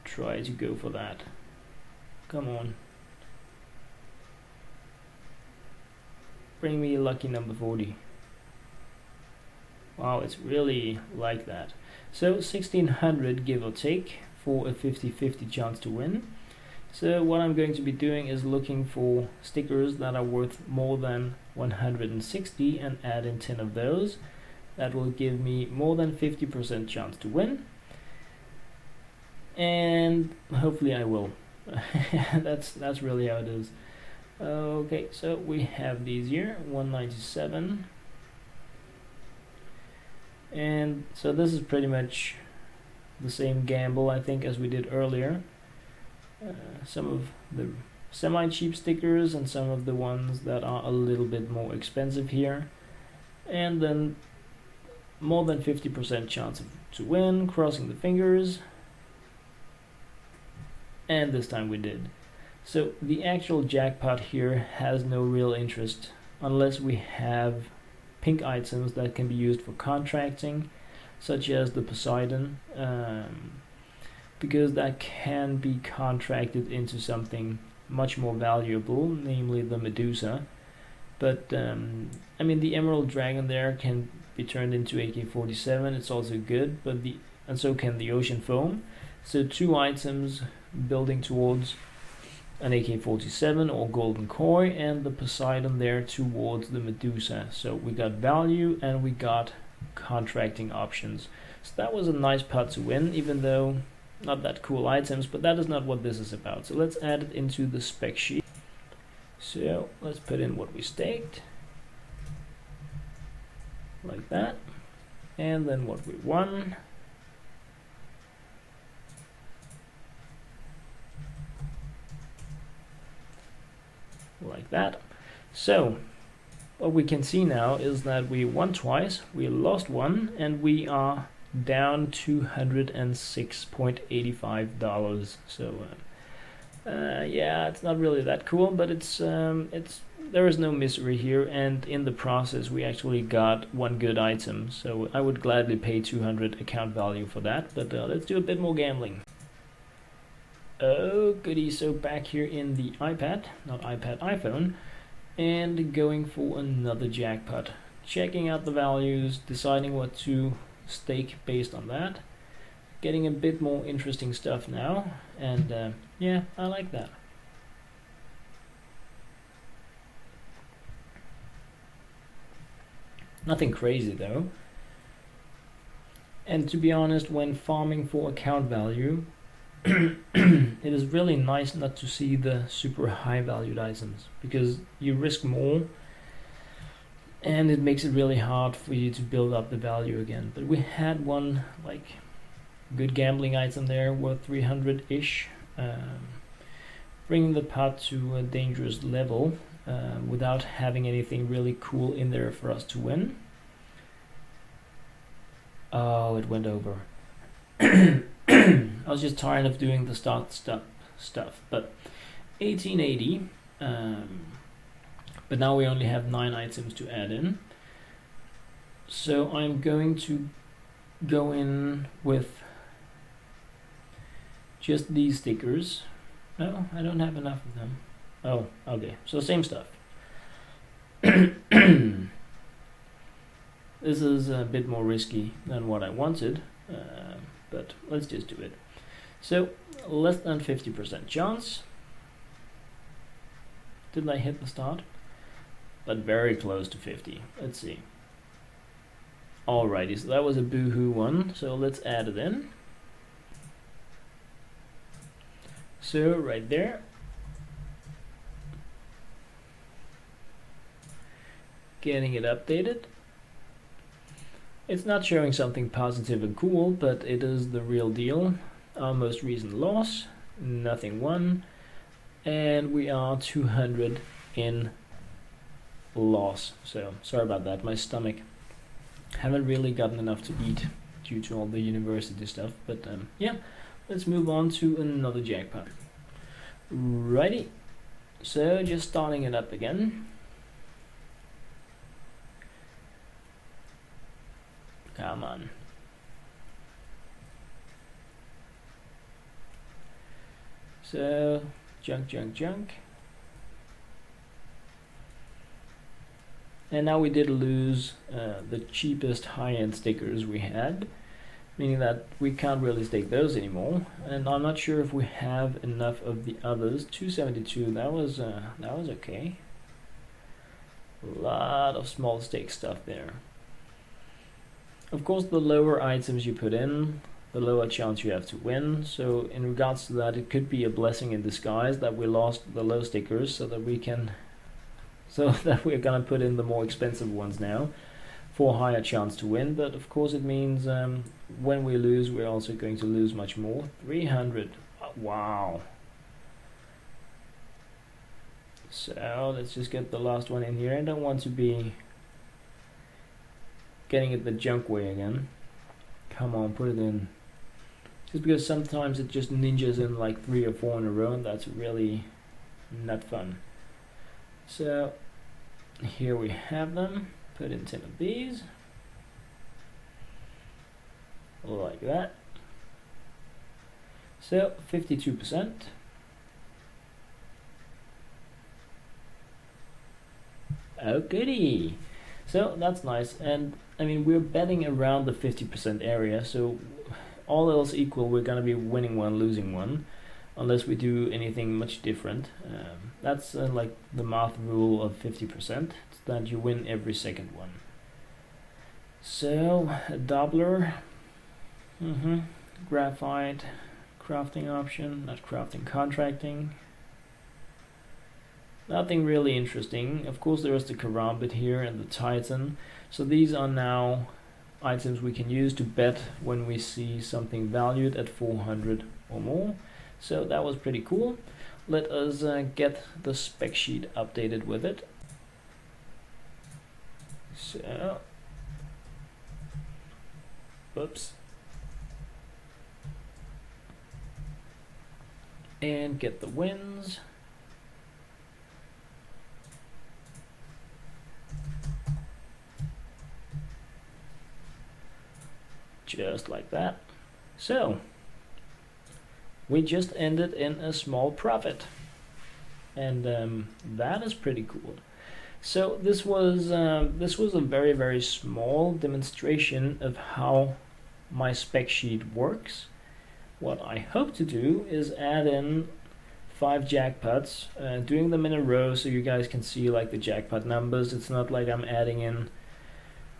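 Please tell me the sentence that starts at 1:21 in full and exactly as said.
But um, I mean, the Emerald Dragon there can be turned into AK-47.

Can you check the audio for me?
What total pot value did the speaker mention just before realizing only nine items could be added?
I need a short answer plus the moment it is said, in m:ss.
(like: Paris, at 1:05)
1880, at 3:32.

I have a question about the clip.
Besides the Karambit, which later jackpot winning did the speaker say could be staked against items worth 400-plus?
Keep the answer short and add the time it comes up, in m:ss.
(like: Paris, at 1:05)
Titan, at 6:52.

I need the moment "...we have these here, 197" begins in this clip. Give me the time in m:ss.
0:35.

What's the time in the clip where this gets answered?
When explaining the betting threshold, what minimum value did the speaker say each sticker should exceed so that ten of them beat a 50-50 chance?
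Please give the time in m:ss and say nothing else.
0:21.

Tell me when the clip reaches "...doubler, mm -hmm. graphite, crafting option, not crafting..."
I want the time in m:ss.
6:40.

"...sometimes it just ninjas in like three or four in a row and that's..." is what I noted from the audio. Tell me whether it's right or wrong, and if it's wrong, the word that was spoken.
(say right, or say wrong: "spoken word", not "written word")
right.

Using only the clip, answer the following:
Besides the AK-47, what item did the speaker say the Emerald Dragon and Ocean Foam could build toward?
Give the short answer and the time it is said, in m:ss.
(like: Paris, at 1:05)
Golden Koi, at 1:33.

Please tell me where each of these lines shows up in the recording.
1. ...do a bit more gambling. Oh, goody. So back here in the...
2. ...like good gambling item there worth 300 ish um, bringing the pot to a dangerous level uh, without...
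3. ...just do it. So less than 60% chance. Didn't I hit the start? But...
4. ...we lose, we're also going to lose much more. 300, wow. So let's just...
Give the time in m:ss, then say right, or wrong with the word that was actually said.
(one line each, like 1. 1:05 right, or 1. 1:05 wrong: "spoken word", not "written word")
1. 2:28 right
2. 3:11 right
3. 3:58 wrong: "50", not "60"
4. 5:41 right.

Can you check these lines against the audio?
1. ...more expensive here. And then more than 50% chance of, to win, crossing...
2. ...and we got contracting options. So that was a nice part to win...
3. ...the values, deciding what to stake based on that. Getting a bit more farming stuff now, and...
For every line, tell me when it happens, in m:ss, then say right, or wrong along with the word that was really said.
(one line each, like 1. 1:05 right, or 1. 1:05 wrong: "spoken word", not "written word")
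1. 0:51 right
2. 1:38 right
3. 2:38 wrong: "interesting", not "farming".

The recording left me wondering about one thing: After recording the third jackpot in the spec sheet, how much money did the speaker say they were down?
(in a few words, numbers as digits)
$206.85.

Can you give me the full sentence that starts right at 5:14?
And I'm not sure if we have enough of the others.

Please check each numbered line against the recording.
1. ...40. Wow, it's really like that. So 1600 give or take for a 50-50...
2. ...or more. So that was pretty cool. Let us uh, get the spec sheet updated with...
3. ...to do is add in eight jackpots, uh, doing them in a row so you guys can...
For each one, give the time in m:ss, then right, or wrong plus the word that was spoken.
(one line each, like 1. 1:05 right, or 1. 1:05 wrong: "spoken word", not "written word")
1. 0:07 right
2. 6:59 right
3. 7:44 wrong: "five", not "eight".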